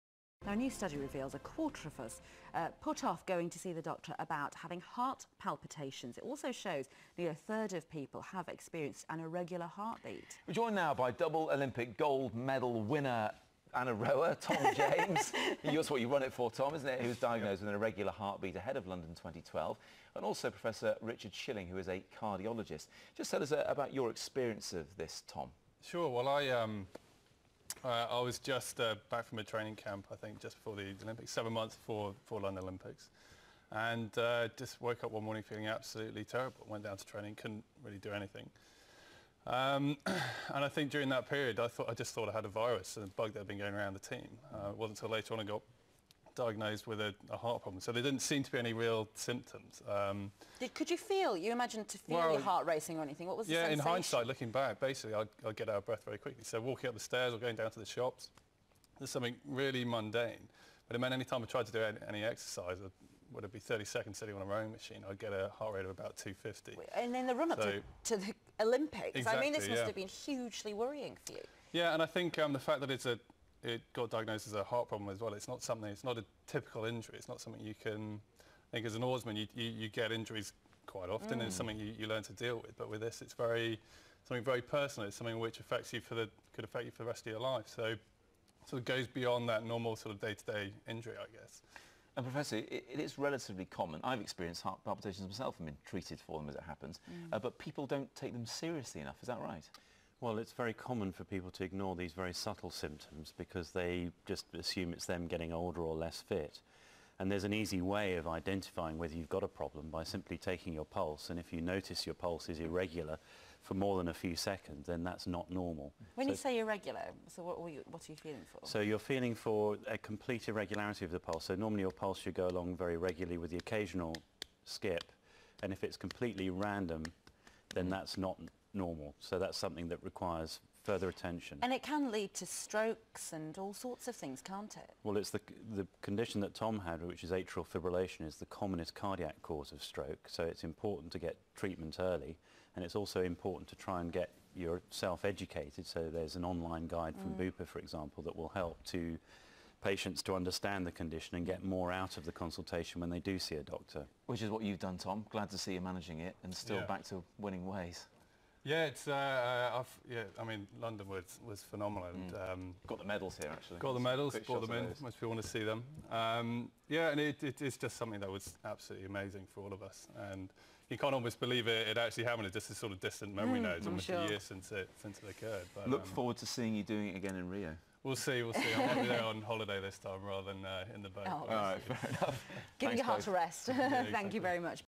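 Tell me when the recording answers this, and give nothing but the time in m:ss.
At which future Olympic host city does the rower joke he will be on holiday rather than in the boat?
2:57.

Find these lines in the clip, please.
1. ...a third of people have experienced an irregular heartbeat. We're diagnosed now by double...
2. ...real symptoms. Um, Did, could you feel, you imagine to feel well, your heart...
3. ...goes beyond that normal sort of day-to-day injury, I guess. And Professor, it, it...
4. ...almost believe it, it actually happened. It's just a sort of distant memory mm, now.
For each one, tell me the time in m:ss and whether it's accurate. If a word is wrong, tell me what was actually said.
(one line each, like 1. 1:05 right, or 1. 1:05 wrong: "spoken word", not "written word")
1. 0:07 wrong: "joined", not "diagnosed"
2. 0:48 right
3. 1:28 right
4. 2:51 right.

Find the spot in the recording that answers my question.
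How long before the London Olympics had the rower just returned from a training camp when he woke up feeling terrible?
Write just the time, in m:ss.
0:31.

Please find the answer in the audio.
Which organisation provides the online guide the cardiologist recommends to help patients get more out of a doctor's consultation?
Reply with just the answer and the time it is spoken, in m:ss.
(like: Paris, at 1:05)
Bupa, at 2:27.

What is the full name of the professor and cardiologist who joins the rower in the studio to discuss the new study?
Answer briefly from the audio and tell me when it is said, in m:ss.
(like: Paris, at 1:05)
Richard Schilling, at 0:20.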